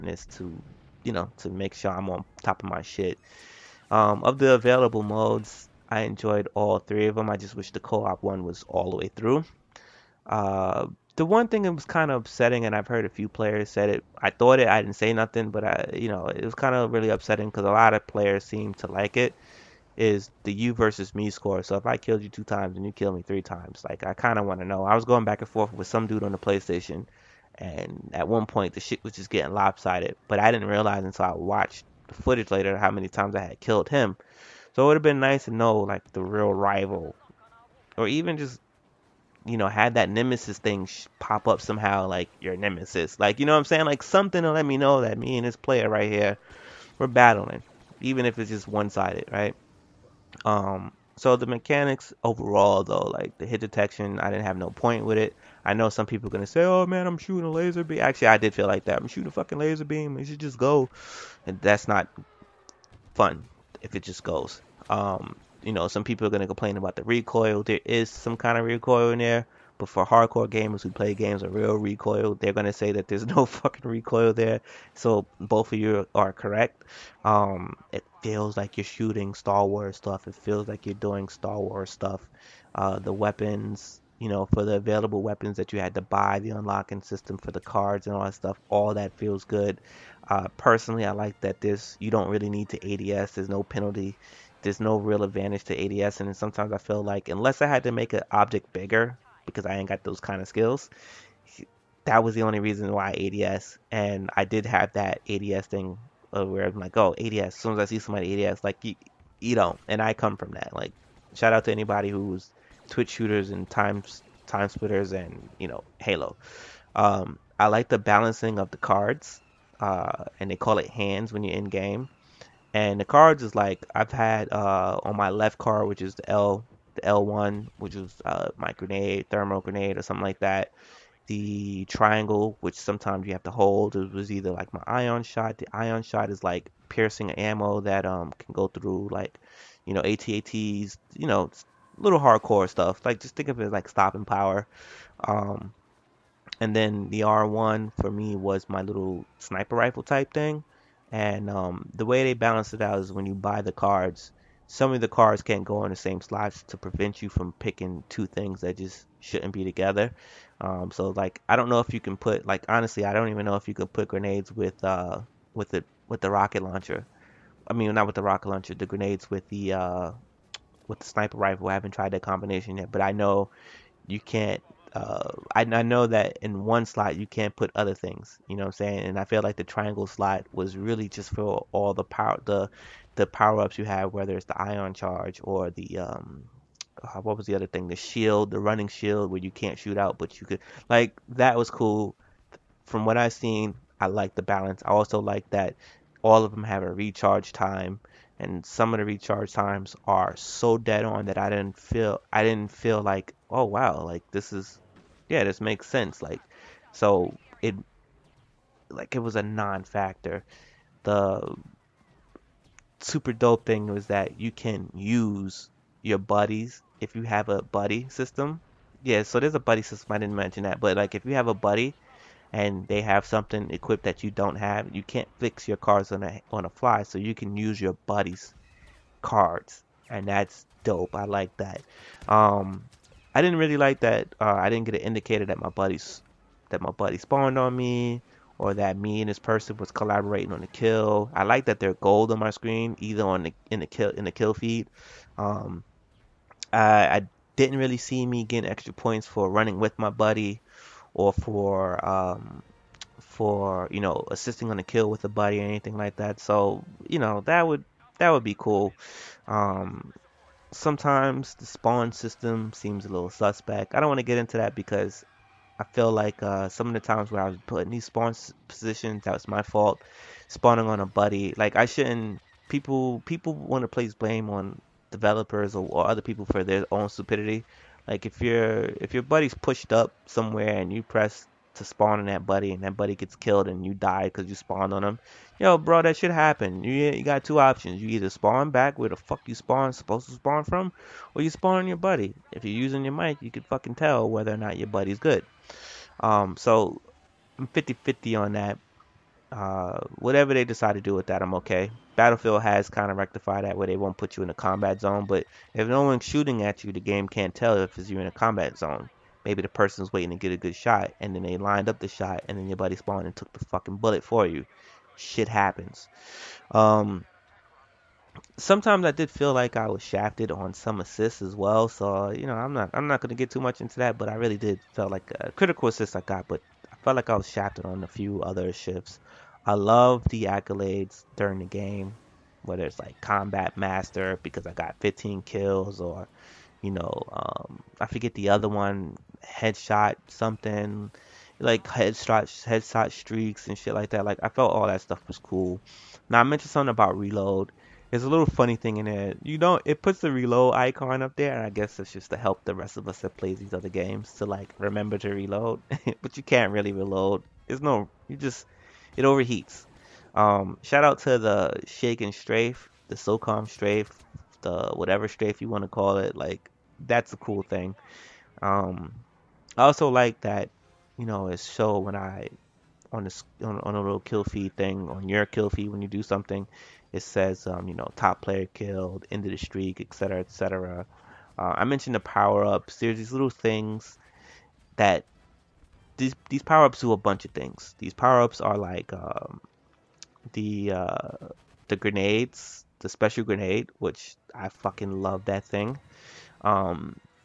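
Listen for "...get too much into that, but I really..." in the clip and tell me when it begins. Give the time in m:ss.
5:23.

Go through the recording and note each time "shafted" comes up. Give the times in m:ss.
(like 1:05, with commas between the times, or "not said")
5:20, 5:27.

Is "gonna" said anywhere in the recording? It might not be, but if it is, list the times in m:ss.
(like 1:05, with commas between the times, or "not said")
0:56, 1:06, 1:12, 5:23.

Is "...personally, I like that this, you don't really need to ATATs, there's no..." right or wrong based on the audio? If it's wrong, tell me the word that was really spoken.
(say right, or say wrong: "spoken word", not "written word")
wrong: "ADS", not "ATATs".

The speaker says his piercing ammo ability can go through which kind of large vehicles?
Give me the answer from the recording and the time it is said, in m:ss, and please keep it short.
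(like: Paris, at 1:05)
ATATs, at 2:20.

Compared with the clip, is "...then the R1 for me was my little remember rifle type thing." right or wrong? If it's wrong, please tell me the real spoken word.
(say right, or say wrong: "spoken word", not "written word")
wrong: "sniper", not "remember".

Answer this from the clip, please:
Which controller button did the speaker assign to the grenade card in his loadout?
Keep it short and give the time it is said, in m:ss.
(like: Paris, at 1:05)
L1, at 2:07.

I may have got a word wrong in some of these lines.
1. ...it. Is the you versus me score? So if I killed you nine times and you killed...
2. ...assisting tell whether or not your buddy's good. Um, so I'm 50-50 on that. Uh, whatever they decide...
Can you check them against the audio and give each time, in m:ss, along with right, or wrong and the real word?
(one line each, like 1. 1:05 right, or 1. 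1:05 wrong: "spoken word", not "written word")
1. 0:19 wrong: "two", not "nine"
2. 4:53 wrong: "fucking", not "assisting".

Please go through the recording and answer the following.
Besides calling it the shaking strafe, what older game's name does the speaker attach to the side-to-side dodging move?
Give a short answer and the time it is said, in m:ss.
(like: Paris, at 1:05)
SOCOM, at 6:03.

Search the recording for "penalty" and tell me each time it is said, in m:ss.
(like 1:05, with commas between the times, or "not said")
1:33.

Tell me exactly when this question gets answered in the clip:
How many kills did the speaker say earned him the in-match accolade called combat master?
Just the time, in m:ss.
5:35.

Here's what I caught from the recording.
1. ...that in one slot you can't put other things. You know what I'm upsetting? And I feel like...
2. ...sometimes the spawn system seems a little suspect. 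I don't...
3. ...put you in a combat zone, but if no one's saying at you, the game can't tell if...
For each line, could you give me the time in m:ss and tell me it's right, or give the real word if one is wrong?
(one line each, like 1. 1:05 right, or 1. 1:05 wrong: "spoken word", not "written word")
1. 2:56 wrong: "saying", not "upsetting"
2. 4:20 right
3. 5:04 wrong: "shooting", not "saying".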